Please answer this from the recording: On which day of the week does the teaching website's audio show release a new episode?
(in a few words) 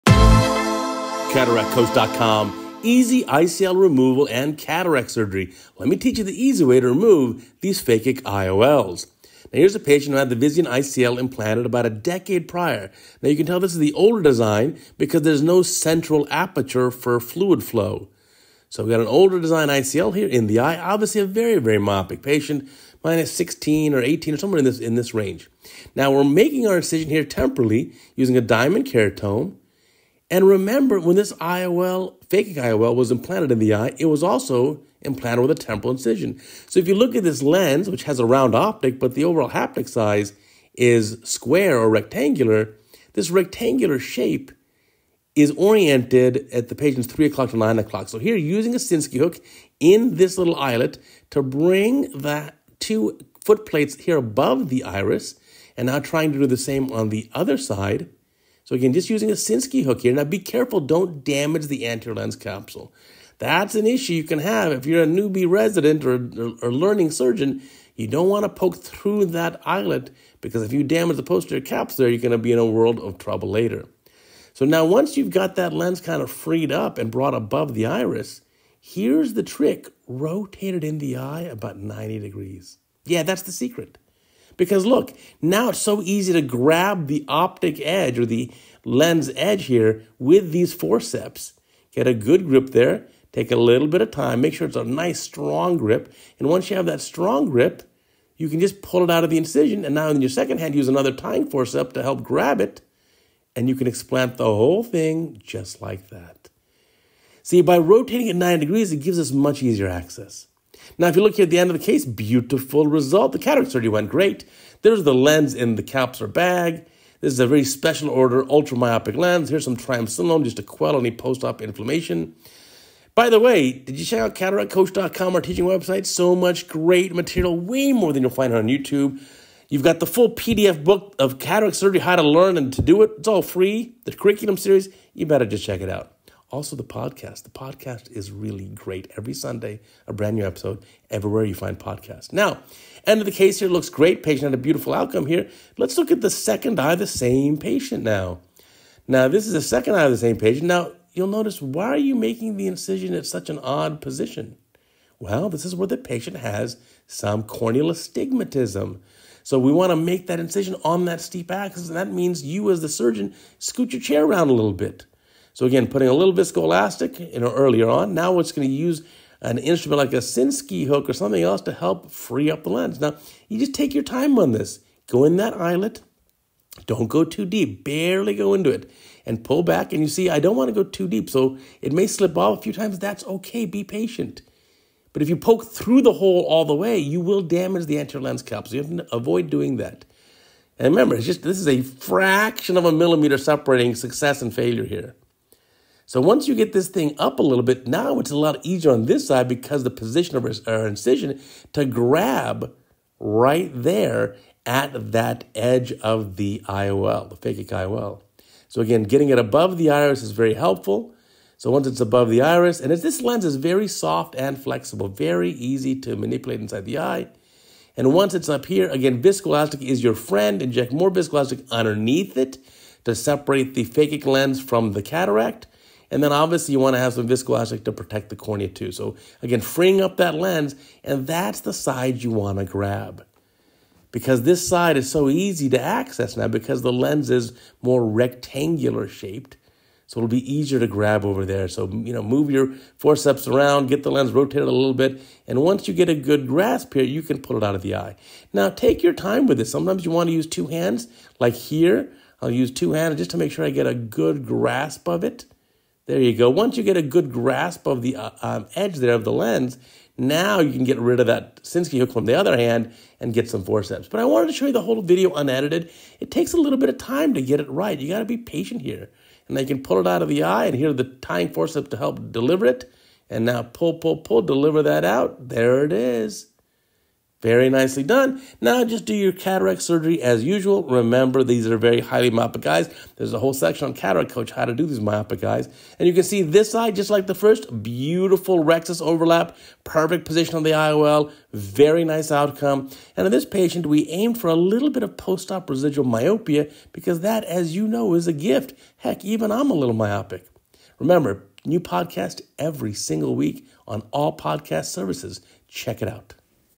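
Sunday.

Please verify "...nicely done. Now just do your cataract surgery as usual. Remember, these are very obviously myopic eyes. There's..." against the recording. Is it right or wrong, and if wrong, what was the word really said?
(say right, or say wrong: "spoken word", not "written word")
wrong: "highly", not "obviously".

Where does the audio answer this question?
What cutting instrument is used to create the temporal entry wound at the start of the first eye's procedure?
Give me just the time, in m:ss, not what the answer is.
0:28.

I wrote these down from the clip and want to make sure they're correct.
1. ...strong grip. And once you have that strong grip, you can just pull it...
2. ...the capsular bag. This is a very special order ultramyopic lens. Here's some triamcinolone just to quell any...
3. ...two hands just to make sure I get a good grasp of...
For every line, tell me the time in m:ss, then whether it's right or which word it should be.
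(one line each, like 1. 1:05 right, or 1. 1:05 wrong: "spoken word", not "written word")
1. 1:35 right
2. 1:55 right
3. 4:12 right.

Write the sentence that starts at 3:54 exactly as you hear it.
Because this side is so easy to access now because the lens is more rectangular shaped.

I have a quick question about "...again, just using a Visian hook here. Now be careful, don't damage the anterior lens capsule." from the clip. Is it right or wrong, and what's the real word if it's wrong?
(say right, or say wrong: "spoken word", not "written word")
wrong: "Sinskey", not "Visian".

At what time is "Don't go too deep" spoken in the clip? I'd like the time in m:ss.
2:56.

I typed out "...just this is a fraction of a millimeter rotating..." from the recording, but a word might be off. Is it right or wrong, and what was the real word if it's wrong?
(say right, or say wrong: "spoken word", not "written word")
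wrong: "separating", not "rotating".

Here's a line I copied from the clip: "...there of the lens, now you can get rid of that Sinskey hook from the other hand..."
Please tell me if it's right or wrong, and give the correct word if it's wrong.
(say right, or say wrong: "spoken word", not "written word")
right.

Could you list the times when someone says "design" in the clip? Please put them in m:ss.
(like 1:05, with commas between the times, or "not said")
0:14, 0:19.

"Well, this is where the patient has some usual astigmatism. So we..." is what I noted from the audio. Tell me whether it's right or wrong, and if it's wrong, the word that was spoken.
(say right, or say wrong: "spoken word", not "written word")
wrong: "corneal", not "usual".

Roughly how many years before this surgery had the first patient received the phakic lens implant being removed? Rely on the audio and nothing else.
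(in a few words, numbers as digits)
about a decade.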